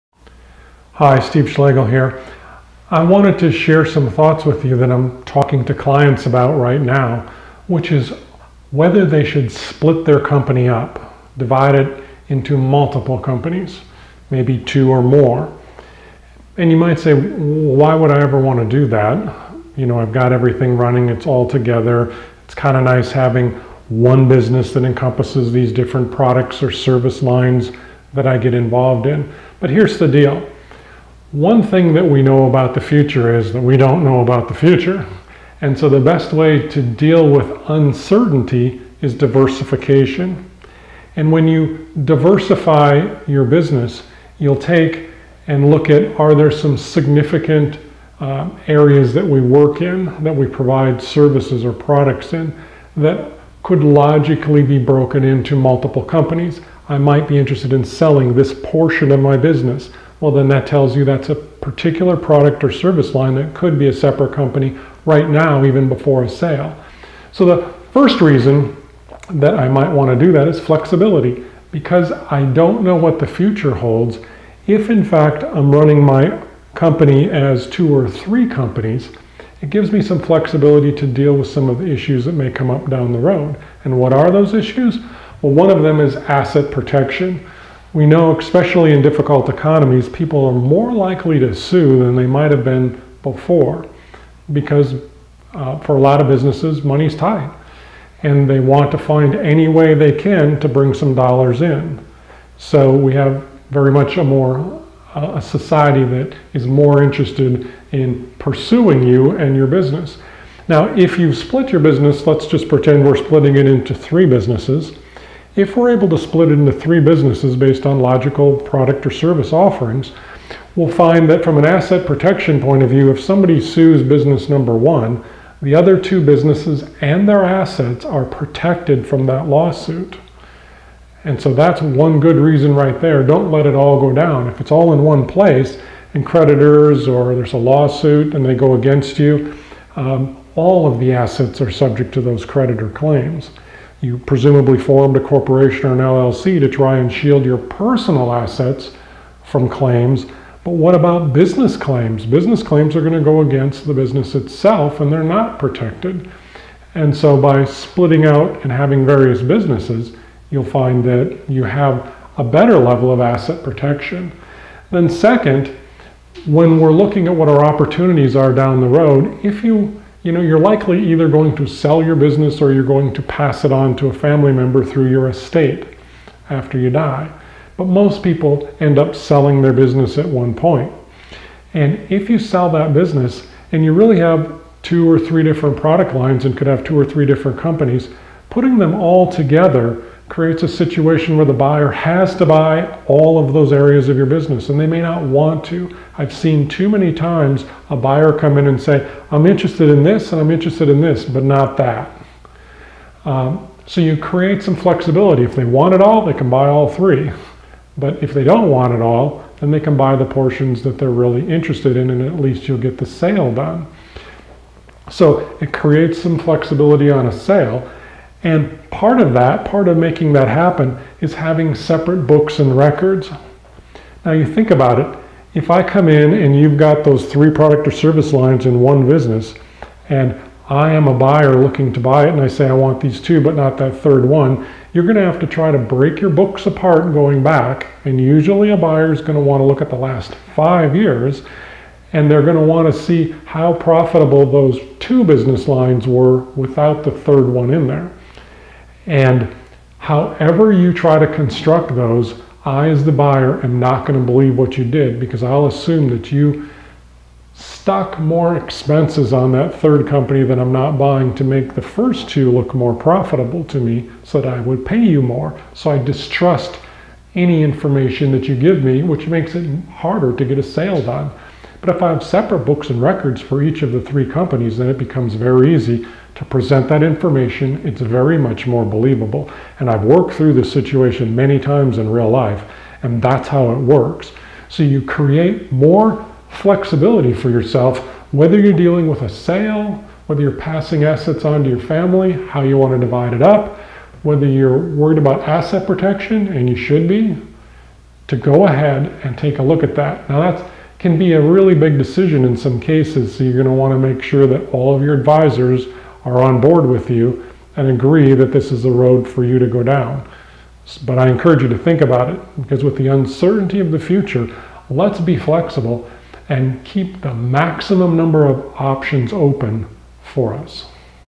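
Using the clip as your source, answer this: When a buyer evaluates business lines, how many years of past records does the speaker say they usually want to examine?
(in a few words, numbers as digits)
5.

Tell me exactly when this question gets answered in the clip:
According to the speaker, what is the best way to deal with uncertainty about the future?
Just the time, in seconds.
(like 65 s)
39 s.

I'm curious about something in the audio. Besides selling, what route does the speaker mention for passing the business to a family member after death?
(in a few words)
Through your estate.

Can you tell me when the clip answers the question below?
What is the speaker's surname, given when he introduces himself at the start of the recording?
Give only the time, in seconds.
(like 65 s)
1 s.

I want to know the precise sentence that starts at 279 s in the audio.
And I've worked through this situation many times in real life, and that's how it works.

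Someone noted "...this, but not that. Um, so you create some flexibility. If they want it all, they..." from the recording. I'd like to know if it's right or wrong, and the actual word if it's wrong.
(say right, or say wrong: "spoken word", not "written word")
right.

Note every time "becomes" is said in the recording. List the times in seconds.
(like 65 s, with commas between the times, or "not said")
274 s.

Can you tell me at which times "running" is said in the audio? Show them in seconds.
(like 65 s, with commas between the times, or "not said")
20 s, 75 s.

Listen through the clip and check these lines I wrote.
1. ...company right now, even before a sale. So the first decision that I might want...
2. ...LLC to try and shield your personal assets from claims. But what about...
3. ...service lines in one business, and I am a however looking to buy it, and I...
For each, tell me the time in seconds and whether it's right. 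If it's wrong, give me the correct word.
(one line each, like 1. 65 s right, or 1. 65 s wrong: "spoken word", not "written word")
1. 64 s wrong: "reason", not "decision"
2. 145 s right
3. 227 s wrong: "buyer", not "however".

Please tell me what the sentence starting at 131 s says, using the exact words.
And so that's one good reason right there.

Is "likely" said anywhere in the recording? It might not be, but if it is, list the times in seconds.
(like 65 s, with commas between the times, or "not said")
90 s, 170 s.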